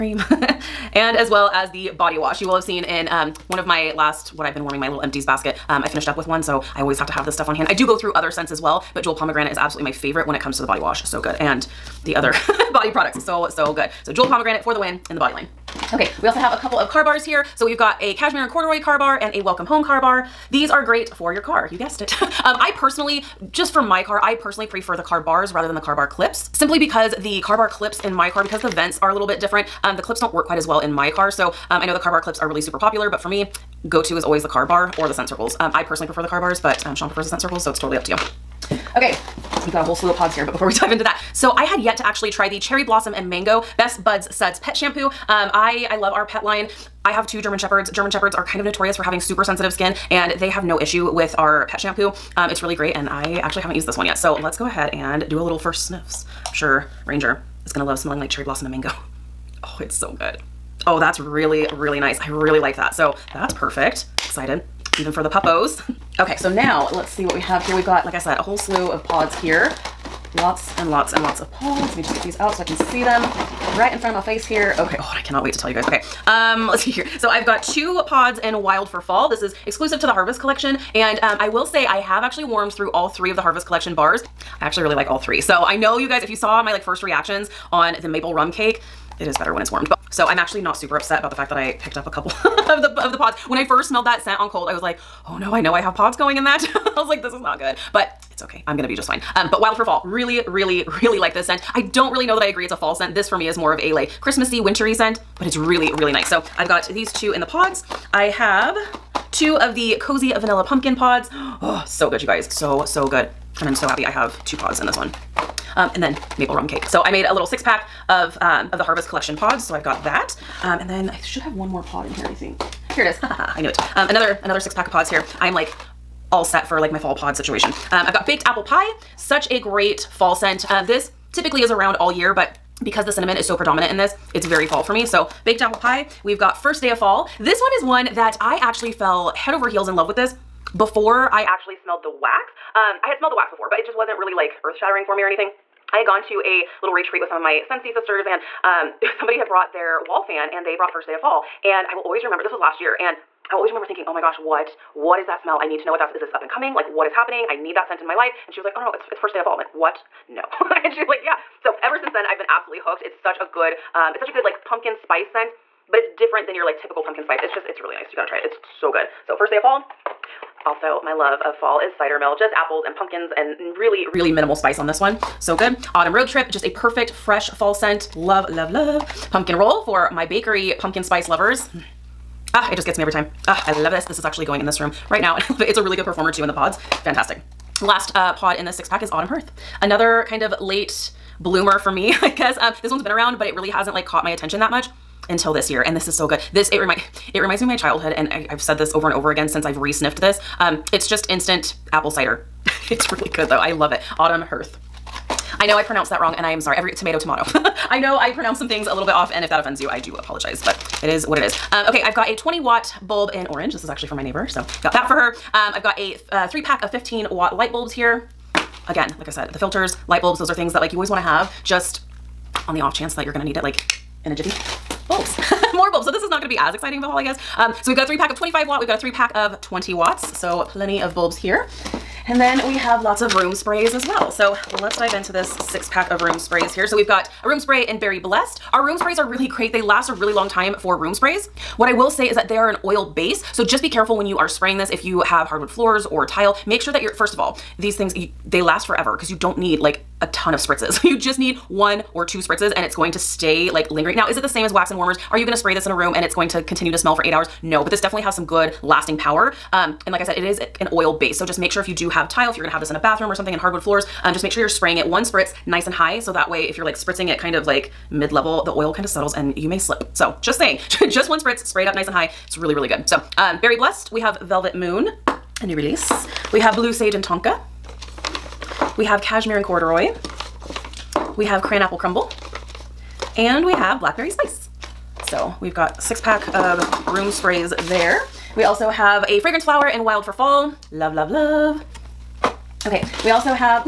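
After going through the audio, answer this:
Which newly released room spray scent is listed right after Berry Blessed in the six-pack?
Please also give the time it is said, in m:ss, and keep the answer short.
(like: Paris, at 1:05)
Velvet Moon, at 4:34.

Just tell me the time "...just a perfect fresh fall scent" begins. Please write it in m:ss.
2:56.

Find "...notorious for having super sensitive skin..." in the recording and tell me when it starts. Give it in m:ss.
0:48.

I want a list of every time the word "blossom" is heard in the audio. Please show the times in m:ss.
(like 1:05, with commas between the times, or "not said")
0:42, 0:58.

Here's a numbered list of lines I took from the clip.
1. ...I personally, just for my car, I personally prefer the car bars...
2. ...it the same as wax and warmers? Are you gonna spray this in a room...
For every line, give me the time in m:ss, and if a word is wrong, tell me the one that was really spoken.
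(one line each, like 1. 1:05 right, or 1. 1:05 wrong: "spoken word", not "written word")
1. 0:22 right
2. 4:14 right.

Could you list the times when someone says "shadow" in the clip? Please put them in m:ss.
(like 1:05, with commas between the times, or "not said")
not said.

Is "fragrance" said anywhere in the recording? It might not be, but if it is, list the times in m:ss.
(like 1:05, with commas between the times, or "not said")
4:49.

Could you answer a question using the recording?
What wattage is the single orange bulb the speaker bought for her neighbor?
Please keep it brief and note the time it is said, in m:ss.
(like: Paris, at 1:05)
20 watt, at 3:32.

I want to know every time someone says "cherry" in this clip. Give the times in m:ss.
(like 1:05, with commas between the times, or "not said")
0:42, 0:58.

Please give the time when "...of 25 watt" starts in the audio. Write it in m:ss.
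3:48.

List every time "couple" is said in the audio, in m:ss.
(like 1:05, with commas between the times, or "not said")
0:16, 1:32.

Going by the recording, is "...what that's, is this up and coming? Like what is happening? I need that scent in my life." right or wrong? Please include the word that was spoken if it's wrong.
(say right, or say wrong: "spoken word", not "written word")
right.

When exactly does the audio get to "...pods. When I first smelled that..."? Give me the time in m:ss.
1:33.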